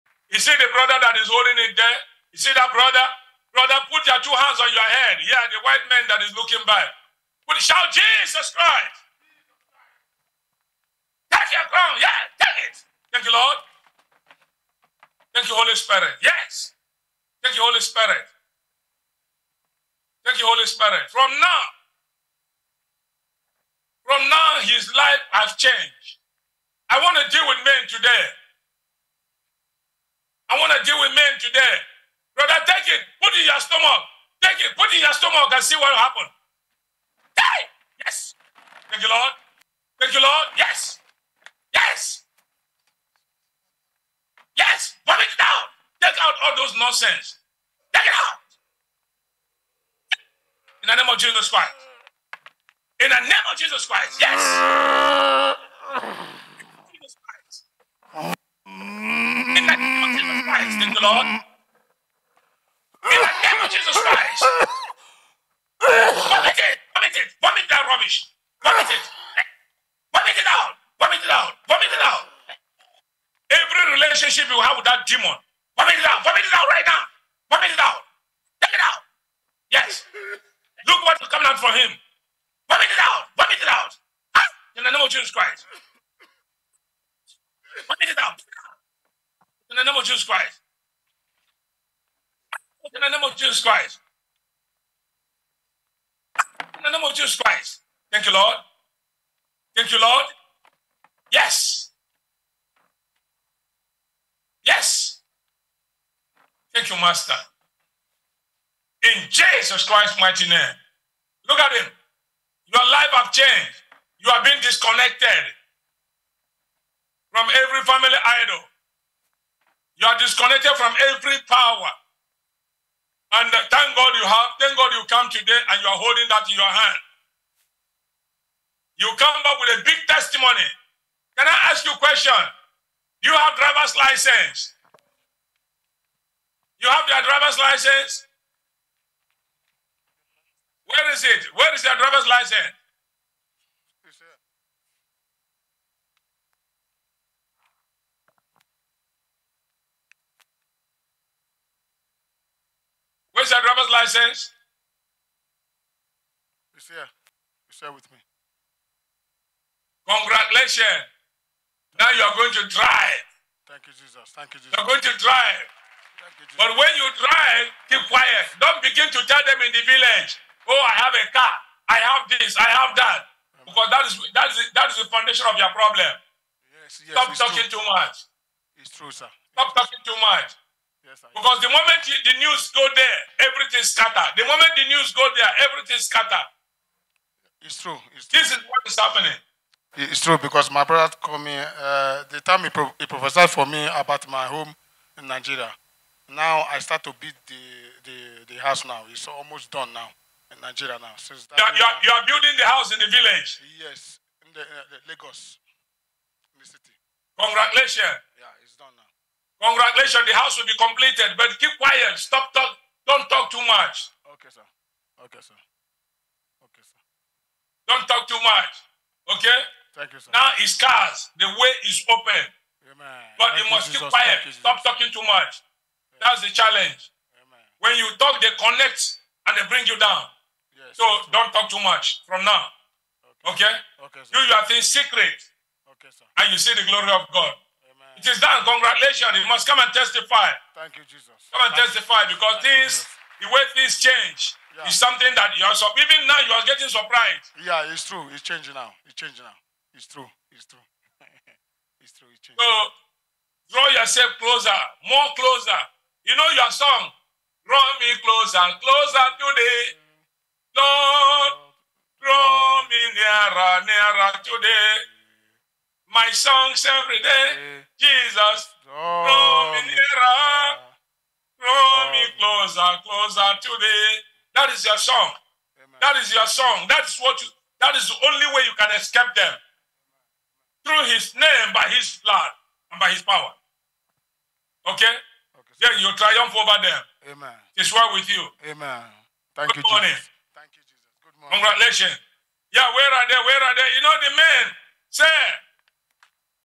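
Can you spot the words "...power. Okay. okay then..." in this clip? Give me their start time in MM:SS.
04:43.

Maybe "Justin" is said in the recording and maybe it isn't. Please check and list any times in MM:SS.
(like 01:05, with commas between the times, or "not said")
not said.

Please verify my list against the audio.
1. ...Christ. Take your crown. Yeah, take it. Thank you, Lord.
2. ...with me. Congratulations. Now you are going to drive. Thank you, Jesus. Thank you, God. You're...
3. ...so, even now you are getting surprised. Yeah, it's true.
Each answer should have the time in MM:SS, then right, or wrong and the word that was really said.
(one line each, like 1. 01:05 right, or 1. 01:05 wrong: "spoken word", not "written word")
1. 00:08 right
2. 02:37 wrong: "Jesus", not "God"
3. 04:05 right.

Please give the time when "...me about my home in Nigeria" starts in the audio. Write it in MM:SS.
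03:13.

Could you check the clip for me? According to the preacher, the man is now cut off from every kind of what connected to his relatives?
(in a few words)
family idol.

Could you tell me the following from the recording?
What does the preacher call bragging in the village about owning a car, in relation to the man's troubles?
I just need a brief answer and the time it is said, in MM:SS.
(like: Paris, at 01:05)
foundation of your problem, at 02:55.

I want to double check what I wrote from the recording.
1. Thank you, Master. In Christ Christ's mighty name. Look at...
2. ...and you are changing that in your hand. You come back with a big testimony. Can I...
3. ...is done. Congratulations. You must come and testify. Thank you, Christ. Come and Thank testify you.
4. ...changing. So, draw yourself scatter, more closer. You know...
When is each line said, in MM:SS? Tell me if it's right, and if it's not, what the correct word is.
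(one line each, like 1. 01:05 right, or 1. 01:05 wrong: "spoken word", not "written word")
1. 01:46 wrong: "Jesus", not "Christ"
2. 02:05 wrong: "holding", not "changing"
3. 03:58 wrong: "Jesus", not "Christ"
4. 04:12 wrong: "closer", not "scatter".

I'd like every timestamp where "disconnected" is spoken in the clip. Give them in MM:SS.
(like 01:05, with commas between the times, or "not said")
01:54, 02:00.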